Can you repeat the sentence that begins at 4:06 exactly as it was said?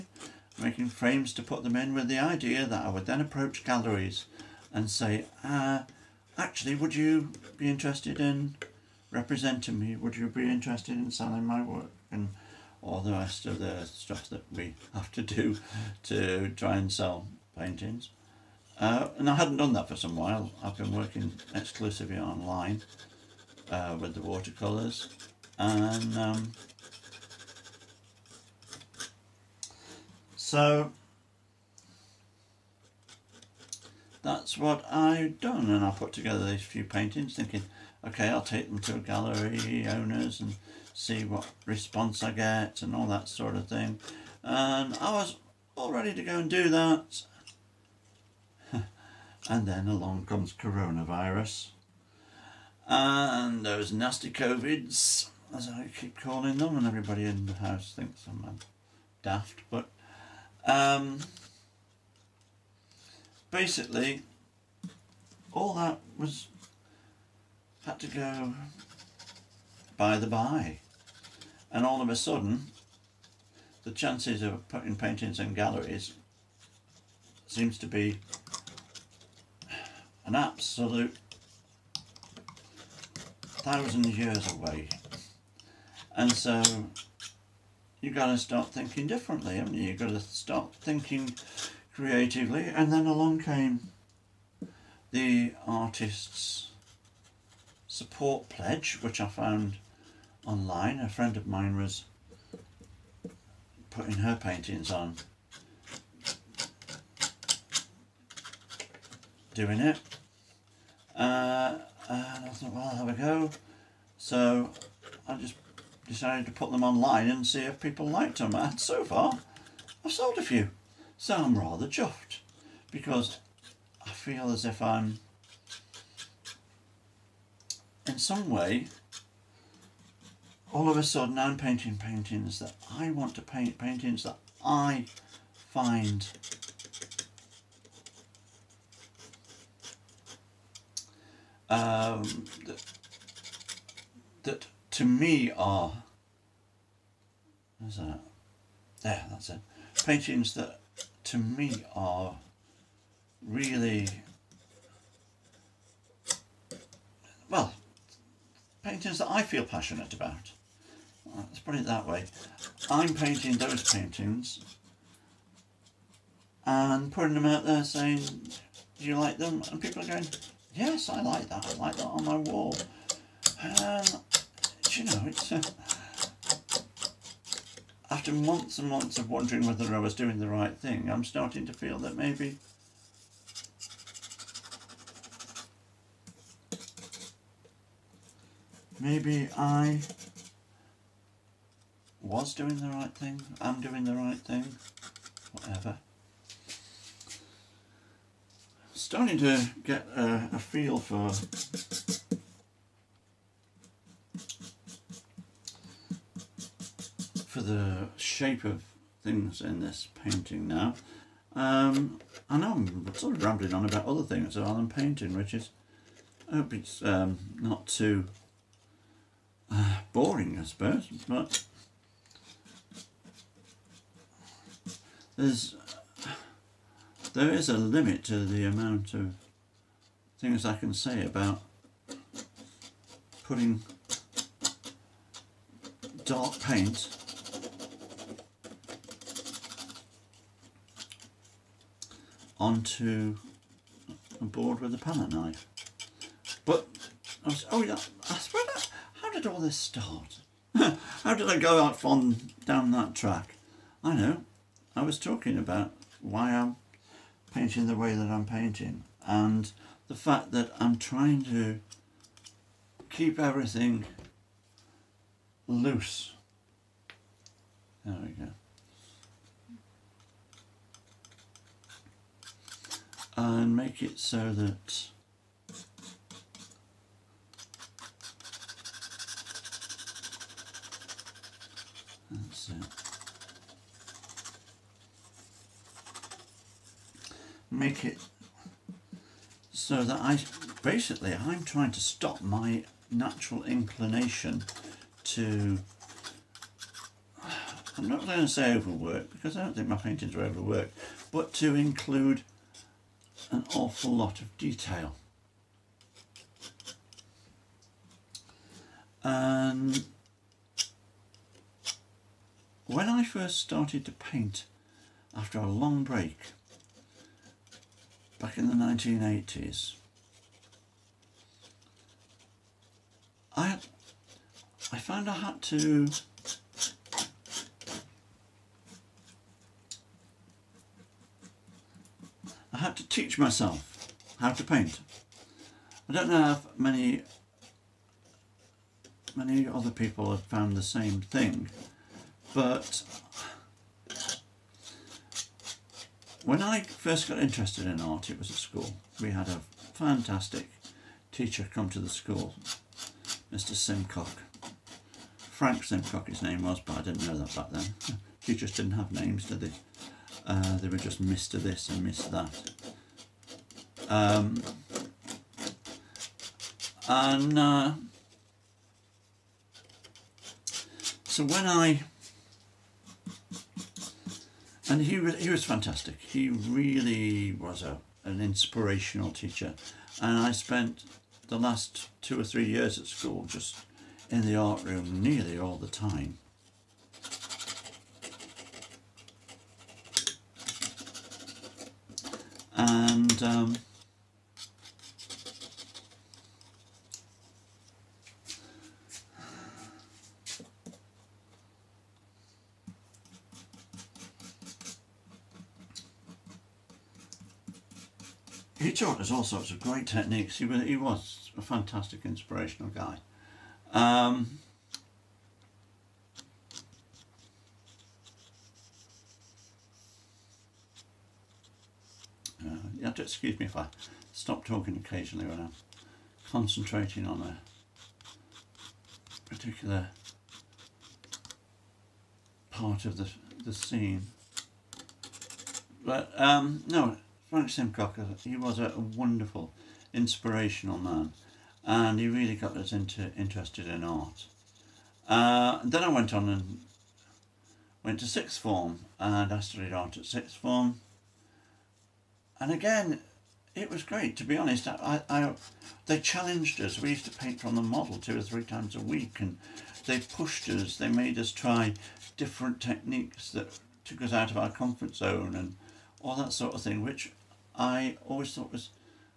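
But, I was, oh yeah, I swear, how did all this start?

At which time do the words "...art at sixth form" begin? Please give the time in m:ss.
7:29.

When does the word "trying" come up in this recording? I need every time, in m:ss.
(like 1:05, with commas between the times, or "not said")
4:20, 4:51.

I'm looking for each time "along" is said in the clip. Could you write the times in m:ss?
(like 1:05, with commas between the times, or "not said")
0:49, 1:33.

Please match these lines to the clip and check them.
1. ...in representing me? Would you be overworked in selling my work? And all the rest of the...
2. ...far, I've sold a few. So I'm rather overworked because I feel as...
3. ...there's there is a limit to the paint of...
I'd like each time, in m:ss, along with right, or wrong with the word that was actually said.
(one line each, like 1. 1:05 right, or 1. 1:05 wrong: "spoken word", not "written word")
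1. 0:08 wrong: "interested", not "overworked"
2. 1:59 wrong: "chuffed", not "overworked"
3. 3:45 wrong: "amount", not "paint".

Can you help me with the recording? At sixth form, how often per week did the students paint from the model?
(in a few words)
2 or 3 times.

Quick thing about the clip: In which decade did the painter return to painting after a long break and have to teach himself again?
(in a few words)
1980s.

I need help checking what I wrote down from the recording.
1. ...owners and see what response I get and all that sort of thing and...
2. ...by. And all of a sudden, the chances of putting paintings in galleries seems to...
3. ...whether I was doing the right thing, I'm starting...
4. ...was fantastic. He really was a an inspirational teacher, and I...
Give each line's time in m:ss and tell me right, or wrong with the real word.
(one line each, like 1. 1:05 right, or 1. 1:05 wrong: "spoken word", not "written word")
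1. 0:39 right
2. 1:10 right
3. 2:59 right
4. 6:15 right.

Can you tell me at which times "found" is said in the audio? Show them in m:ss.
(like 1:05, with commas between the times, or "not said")
1:39, 5:24, 5:40.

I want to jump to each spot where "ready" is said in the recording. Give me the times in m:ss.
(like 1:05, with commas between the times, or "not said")
0:45.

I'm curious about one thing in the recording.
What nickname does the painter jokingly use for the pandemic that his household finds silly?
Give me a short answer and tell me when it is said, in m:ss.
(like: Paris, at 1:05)
Those nasty COVIDs, at 0:53.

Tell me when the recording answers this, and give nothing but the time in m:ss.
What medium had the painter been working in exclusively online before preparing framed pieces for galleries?
0:24.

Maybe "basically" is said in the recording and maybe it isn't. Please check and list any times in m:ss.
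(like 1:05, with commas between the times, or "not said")
1:03, 4:50.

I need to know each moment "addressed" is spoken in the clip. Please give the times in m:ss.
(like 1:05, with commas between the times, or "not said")
not said.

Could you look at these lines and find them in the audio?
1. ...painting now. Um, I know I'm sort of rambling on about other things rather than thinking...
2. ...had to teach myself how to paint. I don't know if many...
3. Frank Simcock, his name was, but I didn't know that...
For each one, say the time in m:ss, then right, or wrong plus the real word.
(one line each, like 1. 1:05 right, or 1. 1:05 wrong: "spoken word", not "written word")
1. 3:30 wrong: "painting", not "thinking"
2. 5:32 right
3. 5:55 right.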